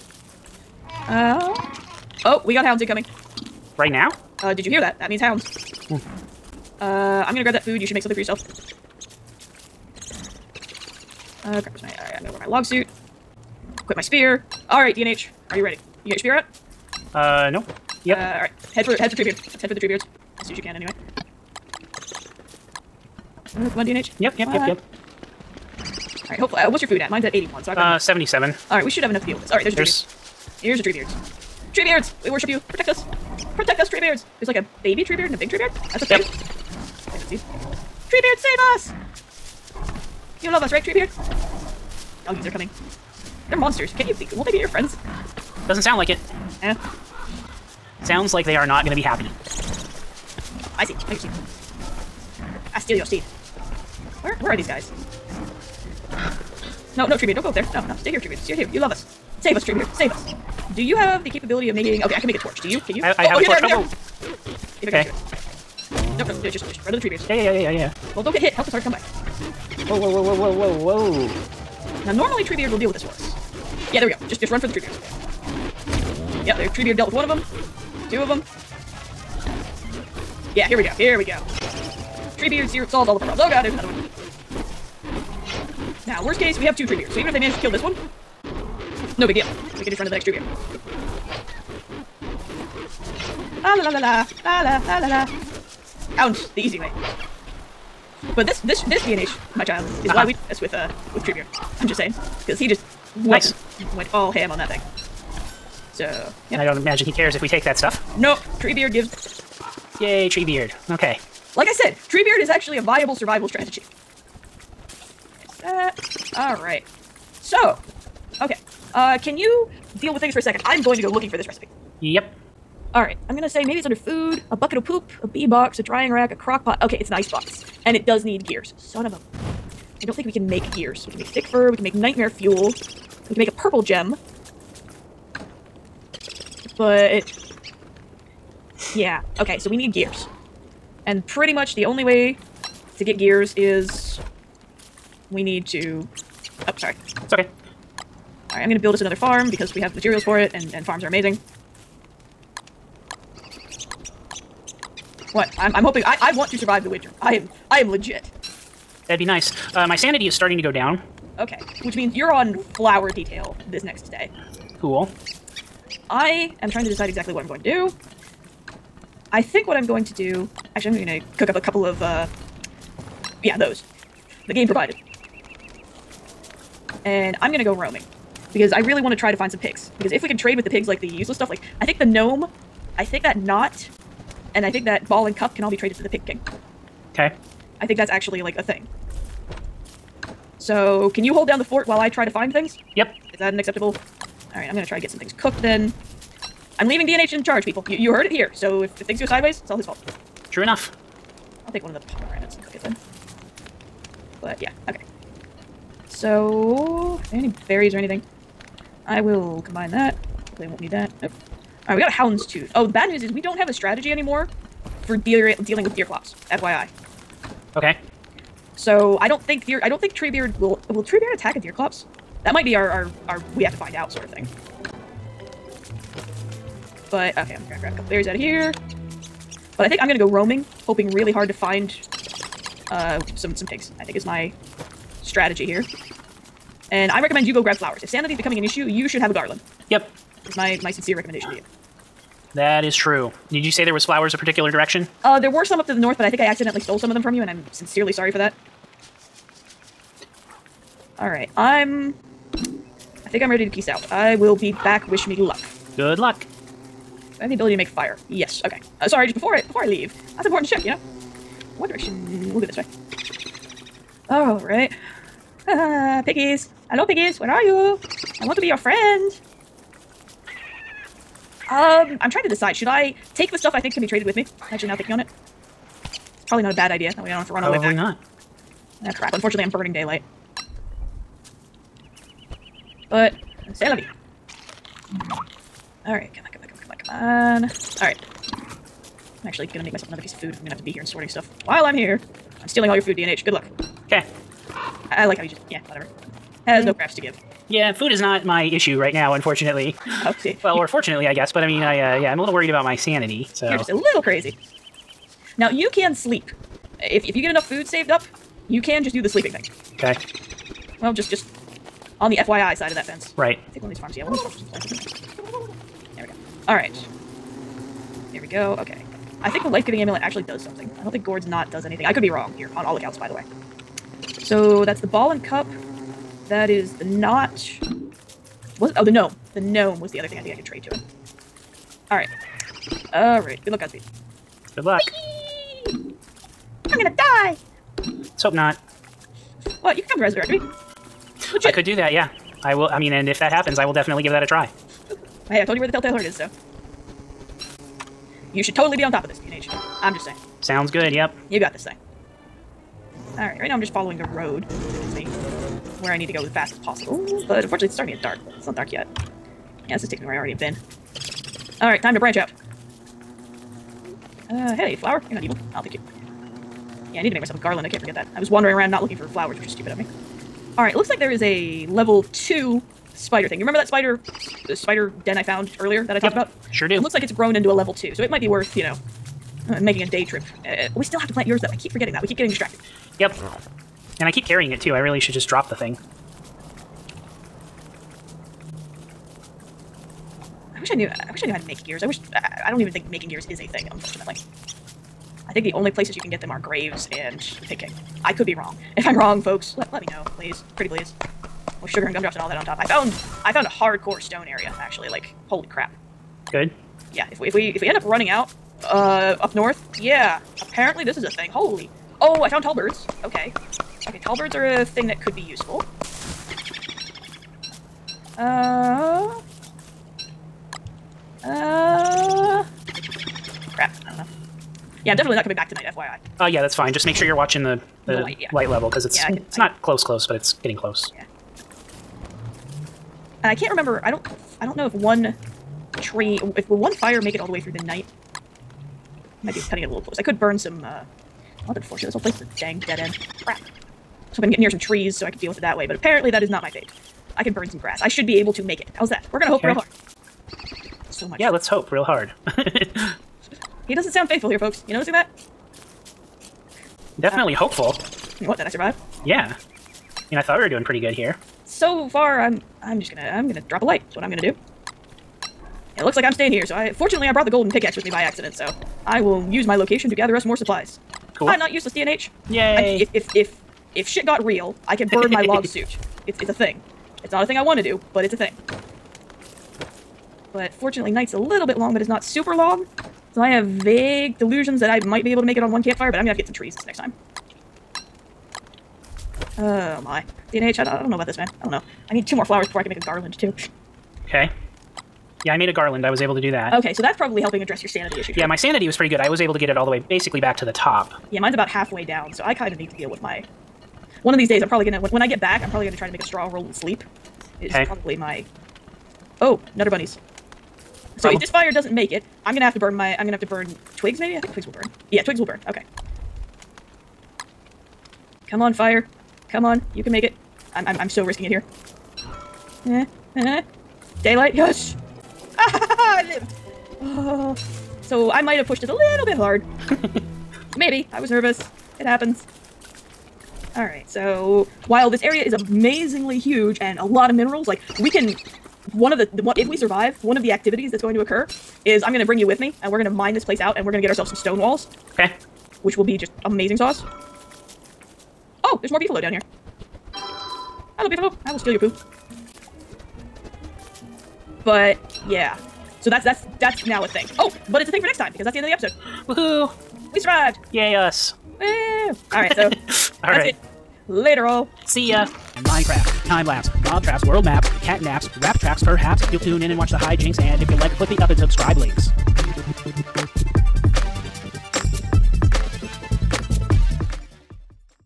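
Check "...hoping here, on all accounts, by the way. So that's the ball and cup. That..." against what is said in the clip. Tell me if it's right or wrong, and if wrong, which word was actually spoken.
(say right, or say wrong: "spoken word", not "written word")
wrong: "wrong", not "hoping".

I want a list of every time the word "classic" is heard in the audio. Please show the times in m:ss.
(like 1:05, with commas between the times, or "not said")
not said.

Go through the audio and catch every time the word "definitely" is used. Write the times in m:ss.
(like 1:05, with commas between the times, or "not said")
5:43, 7:05, 7:37.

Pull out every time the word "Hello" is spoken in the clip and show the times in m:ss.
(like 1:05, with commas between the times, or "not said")
4:26, 9:10.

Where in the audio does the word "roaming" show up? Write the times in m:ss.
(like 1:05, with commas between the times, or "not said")
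2:57, 3:50.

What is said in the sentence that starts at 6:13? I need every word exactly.
You remember that spider uh, spider den I found earlier that I talked yep.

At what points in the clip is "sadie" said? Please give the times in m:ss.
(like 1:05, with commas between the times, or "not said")
not said.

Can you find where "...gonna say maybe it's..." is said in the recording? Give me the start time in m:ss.
2:03.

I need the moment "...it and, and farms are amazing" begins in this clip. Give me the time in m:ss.
2:30.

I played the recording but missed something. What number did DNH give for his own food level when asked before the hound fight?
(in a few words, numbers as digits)
77.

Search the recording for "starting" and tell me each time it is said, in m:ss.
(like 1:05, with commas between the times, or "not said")
2:40, 5:57.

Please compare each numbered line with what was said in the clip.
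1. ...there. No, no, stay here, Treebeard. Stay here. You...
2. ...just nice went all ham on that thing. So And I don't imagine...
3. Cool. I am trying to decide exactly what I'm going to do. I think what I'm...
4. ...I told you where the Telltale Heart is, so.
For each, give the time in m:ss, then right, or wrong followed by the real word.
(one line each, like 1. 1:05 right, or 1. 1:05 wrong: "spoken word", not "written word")
1. 0:57 right
2. 1:42 right
3. 2:44 right
4. 5:45 right.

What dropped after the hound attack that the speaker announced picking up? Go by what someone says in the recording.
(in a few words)
hound's tooth.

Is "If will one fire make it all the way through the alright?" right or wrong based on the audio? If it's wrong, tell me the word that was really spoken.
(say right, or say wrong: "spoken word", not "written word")
wrong: "night", not "alright".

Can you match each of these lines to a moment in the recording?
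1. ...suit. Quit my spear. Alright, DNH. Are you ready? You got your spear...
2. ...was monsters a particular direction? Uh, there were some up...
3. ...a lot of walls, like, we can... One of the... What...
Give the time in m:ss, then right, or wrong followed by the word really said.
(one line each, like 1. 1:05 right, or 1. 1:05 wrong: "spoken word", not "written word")
1. 0:12 right
2. 4:03 wrong: "flowers", not "monsters"
3. 8:56 wrong: "minerals", not "walls".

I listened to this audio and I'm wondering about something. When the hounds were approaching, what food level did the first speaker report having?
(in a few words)
81.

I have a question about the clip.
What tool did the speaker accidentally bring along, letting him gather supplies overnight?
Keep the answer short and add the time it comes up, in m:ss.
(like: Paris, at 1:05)
golden pickaxe, at 7:47.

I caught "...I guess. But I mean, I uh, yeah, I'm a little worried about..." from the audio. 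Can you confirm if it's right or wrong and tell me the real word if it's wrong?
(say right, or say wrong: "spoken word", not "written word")
right.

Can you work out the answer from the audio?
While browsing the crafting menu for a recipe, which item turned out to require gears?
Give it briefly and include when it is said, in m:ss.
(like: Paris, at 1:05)
ice box, at 2:07.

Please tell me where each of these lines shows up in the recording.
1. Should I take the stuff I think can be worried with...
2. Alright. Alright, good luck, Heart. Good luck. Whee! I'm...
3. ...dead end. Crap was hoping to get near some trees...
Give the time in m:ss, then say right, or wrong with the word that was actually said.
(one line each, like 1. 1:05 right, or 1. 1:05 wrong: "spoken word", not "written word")
1. 4:32 wrong: "traded", not "worried"
2. 5:32 wrong: "Godspeed", not "Heart"
3. 7:22 right.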